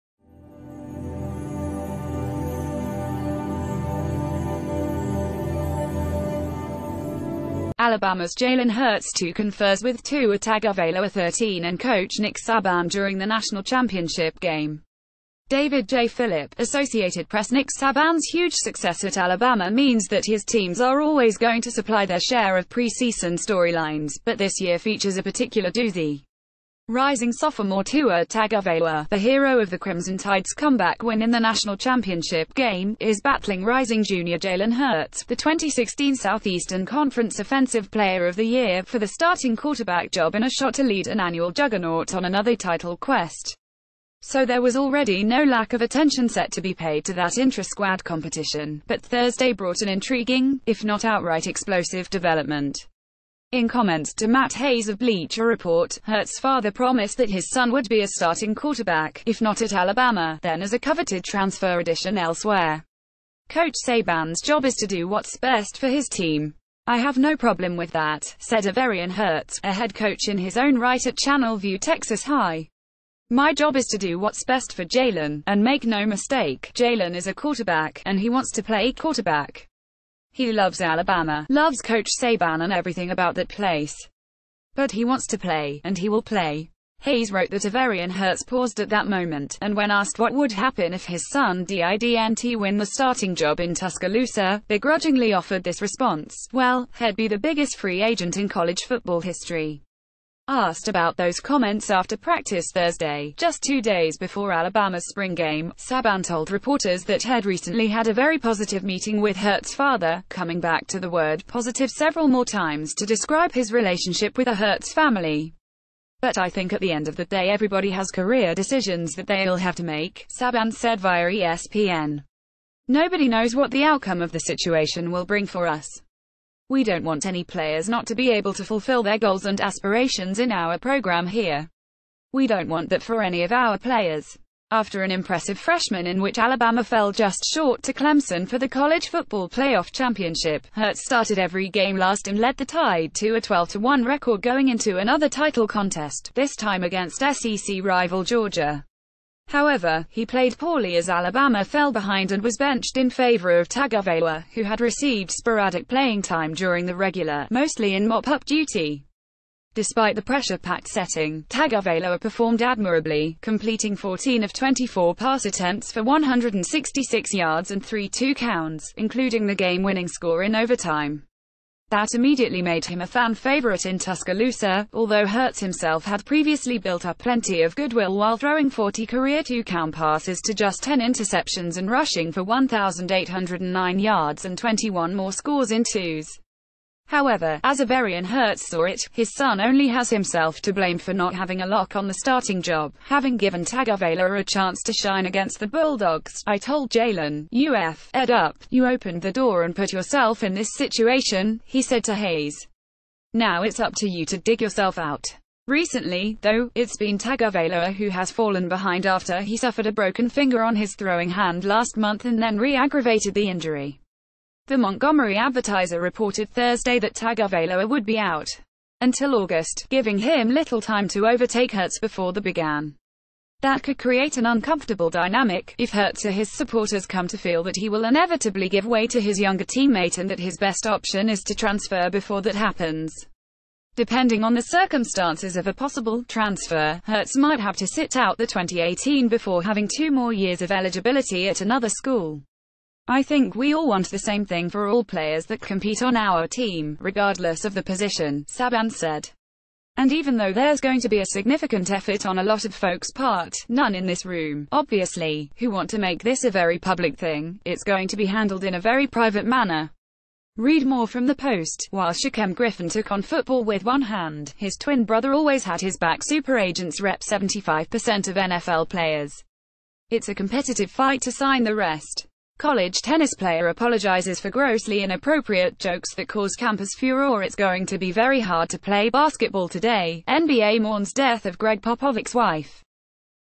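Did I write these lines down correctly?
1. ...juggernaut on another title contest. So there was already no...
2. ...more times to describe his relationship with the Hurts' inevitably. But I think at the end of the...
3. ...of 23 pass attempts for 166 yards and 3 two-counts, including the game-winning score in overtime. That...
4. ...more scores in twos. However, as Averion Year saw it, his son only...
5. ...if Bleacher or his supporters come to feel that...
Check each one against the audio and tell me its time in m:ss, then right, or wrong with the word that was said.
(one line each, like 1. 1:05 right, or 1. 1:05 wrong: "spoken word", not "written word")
1. 0:41 wrong: "quest", not "contest"
2. 1:52 wrong: "family", not "inevitably"
3. 2:44 wrong: "24", not "23"
4. 3:05 wrong: "Hurts", not "Year"
5. 3:45 wrong: "Hurts", not "Bleacher".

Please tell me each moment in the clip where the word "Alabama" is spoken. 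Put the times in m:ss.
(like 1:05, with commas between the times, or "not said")
0:07, 0:19, 0:59, 1:20, 1:44, 2:16, 2:31.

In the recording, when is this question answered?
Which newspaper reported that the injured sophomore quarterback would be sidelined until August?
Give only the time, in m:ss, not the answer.
3:34.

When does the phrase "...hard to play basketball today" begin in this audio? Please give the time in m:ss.
4:38.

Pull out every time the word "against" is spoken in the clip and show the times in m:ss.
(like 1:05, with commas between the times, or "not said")
2:26, 3:15.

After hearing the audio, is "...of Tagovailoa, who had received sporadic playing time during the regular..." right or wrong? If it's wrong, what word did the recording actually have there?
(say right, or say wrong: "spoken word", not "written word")
right.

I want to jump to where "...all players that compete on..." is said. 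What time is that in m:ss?
4:04.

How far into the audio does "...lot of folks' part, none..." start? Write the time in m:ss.
4:12.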